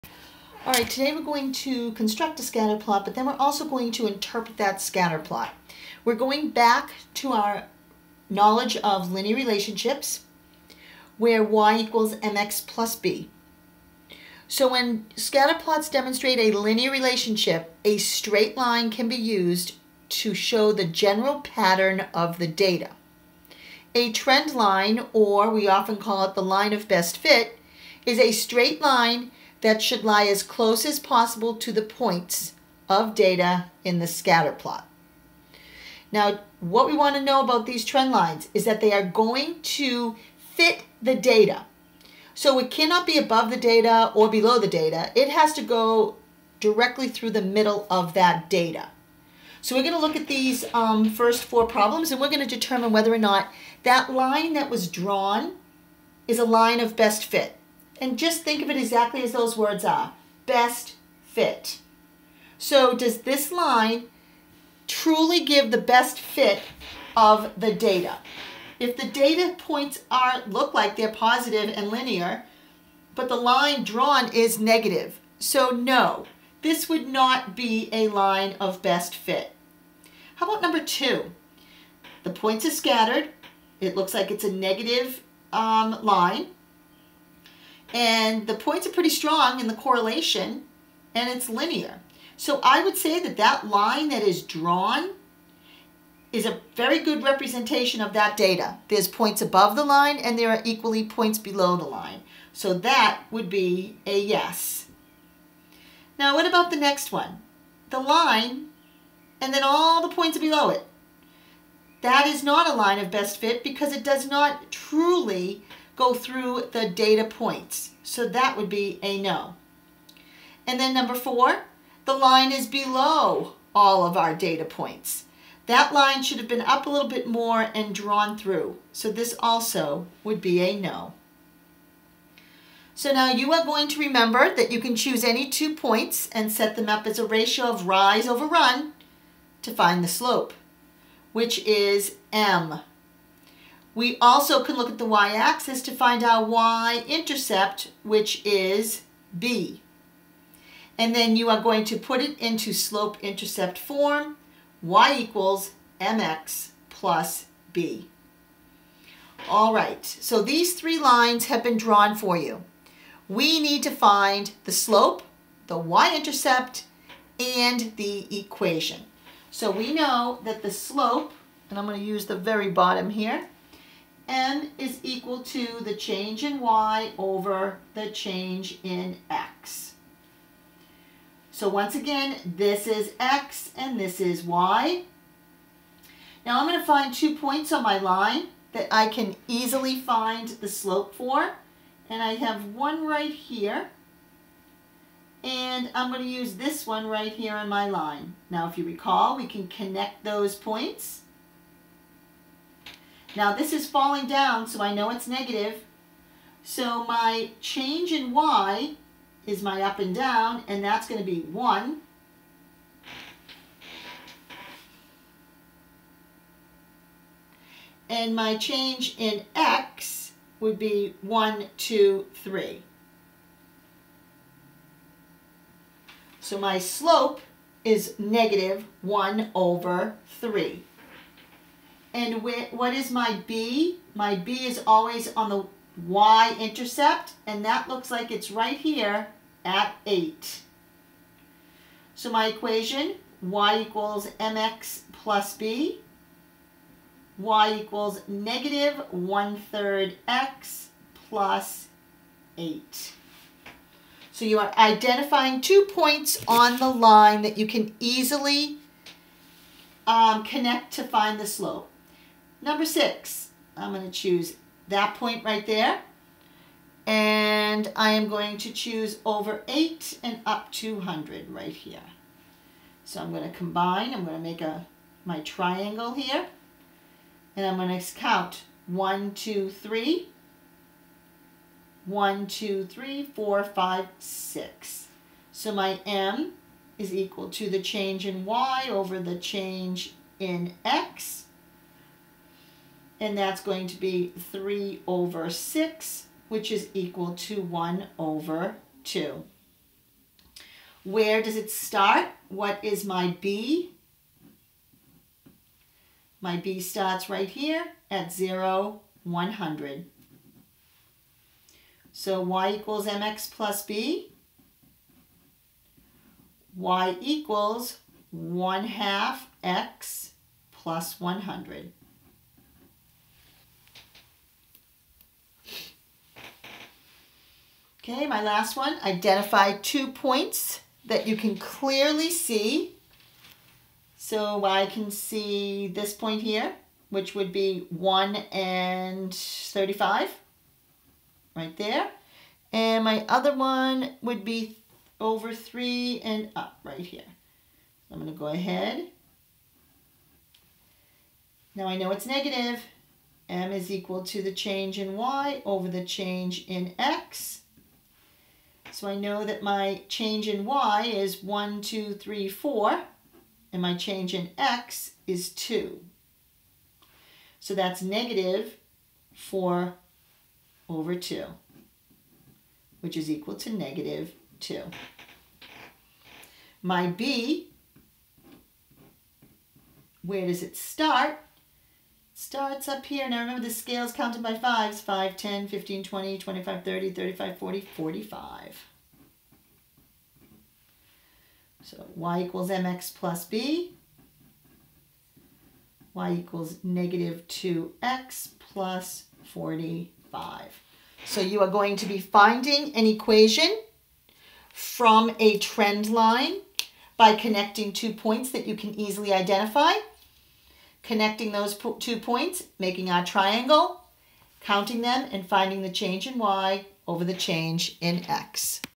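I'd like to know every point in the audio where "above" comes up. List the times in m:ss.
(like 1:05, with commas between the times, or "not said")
0:43, 1:39.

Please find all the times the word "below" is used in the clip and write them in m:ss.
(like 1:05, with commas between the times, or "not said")
0:44, 1:41, 1:50, 2:02.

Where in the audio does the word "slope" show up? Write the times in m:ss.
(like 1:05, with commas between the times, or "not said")
2:20, 2:32, 2:44, 2:50, 3:10, 3:46, 4:21.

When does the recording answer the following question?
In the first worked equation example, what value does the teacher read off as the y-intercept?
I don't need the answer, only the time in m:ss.
3:57.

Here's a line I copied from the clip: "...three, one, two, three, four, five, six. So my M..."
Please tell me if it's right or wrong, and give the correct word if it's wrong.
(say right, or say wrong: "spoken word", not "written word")
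right.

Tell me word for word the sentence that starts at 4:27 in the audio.
And I am going to choose over eight and up 200 right here.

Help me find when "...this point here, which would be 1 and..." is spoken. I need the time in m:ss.
5:35.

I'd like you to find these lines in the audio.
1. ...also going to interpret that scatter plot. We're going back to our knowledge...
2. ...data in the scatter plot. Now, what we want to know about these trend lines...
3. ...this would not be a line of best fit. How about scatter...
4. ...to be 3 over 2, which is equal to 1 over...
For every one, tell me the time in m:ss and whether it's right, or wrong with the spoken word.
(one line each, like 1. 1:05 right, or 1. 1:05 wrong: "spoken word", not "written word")
1. 0:03 right
2. 0:33 right
3. 1:16 wrong: "number", not "scatter"
4. 4:53 wrong: "6", not "2".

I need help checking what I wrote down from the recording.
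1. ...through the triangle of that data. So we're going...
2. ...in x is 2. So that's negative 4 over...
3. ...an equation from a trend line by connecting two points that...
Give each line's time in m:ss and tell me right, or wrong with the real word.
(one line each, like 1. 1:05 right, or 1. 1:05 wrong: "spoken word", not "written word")
1. 0:47 wrong: "middle", not "triangle"
2. 6:04 right
3. 6:42 right.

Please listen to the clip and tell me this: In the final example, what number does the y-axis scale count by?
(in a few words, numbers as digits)
5.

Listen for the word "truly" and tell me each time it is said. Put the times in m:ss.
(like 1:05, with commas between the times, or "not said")
1:04, 1:54.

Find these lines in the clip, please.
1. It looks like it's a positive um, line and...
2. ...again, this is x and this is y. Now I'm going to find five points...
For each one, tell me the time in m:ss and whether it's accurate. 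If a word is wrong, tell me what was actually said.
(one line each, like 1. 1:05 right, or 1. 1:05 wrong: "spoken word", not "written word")
1. 1:23 wrong: "negative", not "positive"
2. 3:01 wrong: "two", not "five".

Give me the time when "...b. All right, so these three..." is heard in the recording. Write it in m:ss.
2:37.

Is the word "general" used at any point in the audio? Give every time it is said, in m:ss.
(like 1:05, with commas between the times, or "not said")
0:20.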